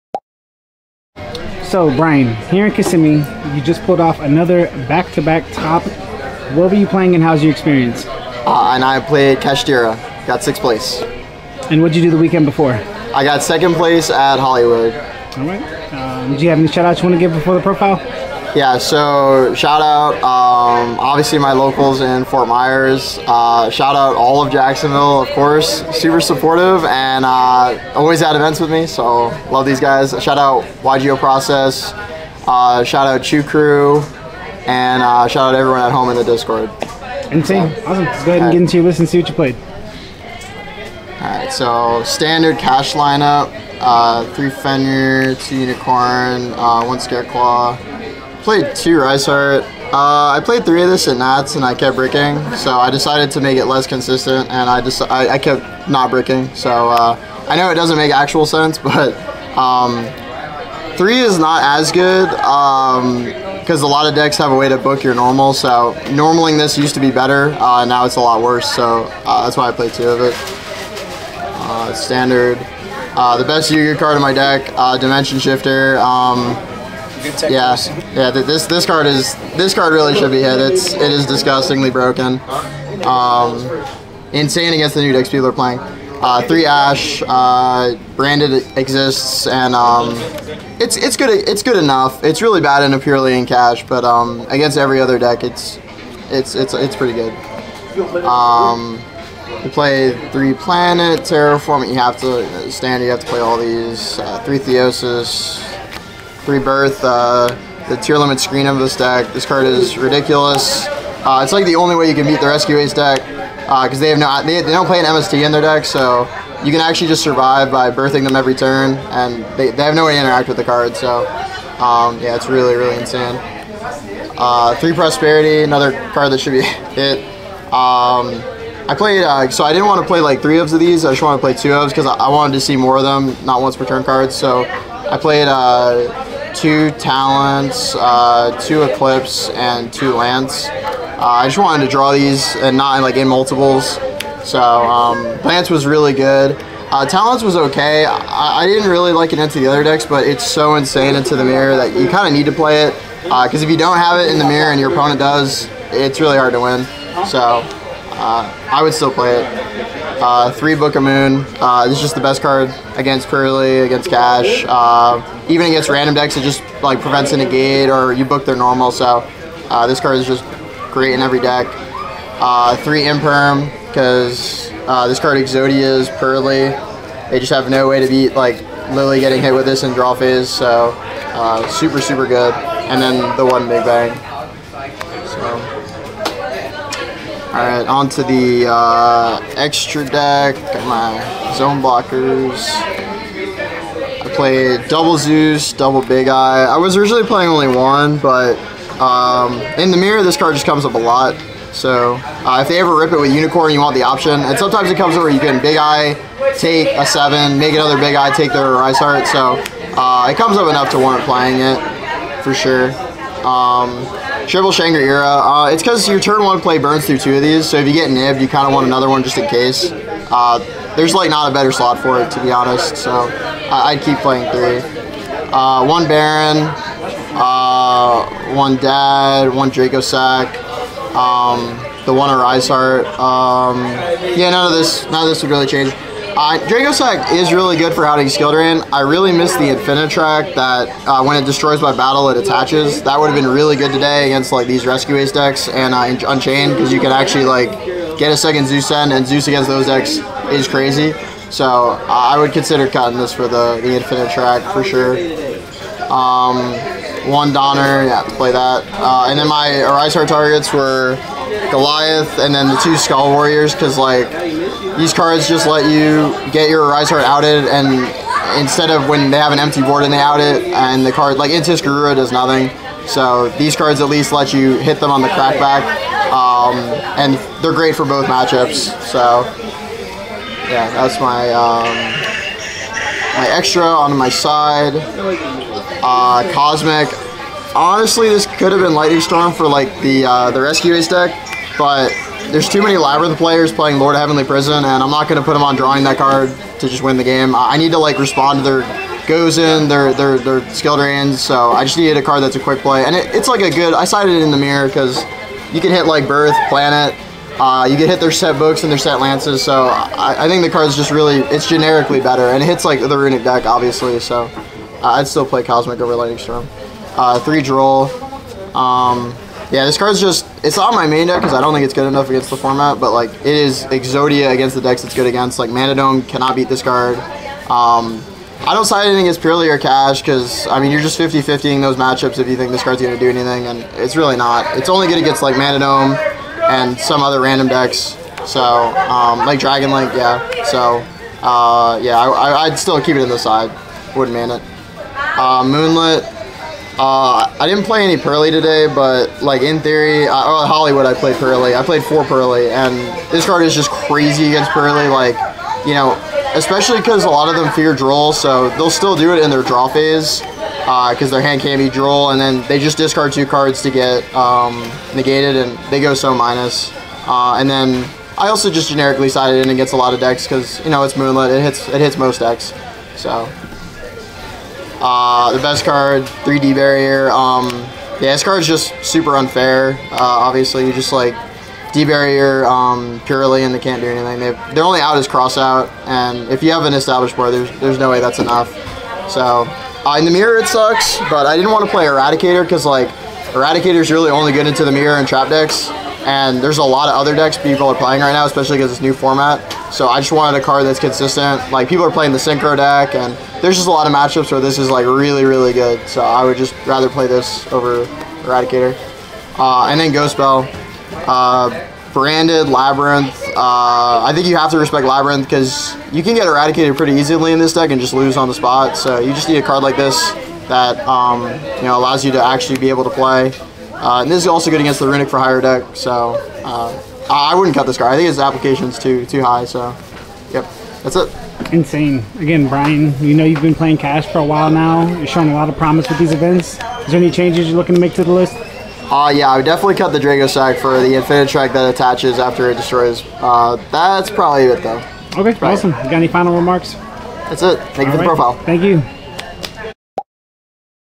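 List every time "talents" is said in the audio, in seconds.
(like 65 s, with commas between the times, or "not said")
136 s, 147 s.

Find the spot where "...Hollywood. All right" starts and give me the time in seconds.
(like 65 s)
14 s.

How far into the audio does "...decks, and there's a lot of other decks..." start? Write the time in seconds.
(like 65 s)
395 s.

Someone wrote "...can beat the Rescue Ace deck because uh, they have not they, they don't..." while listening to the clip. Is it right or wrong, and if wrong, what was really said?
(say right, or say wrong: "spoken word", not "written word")
right.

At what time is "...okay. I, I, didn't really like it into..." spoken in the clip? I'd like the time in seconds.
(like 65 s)
147 s.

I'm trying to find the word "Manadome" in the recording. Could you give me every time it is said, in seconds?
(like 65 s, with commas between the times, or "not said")
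325 s, 335 s.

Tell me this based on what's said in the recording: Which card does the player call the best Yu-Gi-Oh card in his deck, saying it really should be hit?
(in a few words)
Dimension Shifter.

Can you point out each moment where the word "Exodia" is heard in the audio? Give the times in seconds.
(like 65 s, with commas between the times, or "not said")
175 s, 323 s.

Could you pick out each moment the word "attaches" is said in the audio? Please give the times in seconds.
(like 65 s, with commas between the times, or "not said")
242 s, 441 s.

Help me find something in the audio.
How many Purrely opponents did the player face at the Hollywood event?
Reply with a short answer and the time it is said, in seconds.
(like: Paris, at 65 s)
4, at 352 s.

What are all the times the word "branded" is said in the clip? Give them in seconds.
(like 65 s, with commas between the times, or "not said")
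88 s, 412 s.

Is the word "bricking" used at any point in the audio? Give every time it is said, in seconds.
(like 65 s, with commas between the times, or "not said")
51 s, 56 s.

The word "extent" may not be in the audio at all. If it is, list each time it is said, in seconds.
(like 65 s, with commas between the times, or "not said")
not said.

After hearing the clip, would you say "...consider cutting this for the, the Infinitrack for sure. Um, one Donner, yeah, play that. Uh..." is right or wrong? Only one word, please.
right.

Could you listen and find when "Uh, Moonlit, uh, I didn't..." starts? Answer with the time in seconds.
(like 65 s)
345 s.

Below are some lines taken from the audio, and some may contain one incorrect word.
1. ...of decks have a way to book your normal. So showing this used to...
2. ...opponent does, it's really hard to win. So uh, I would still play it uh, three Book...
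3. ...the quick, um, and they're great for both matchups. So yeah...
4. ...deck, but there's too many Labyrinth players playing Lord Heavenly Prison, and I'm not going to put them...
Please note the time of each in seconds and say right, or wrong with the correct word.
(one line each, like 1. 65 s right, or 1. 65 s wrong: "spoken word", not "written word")
1. 64 s wrong: "normaling", not "showing"
2. 154 s right
3. 275 s wrong: "crackback", not "quick"
4. 291 s right.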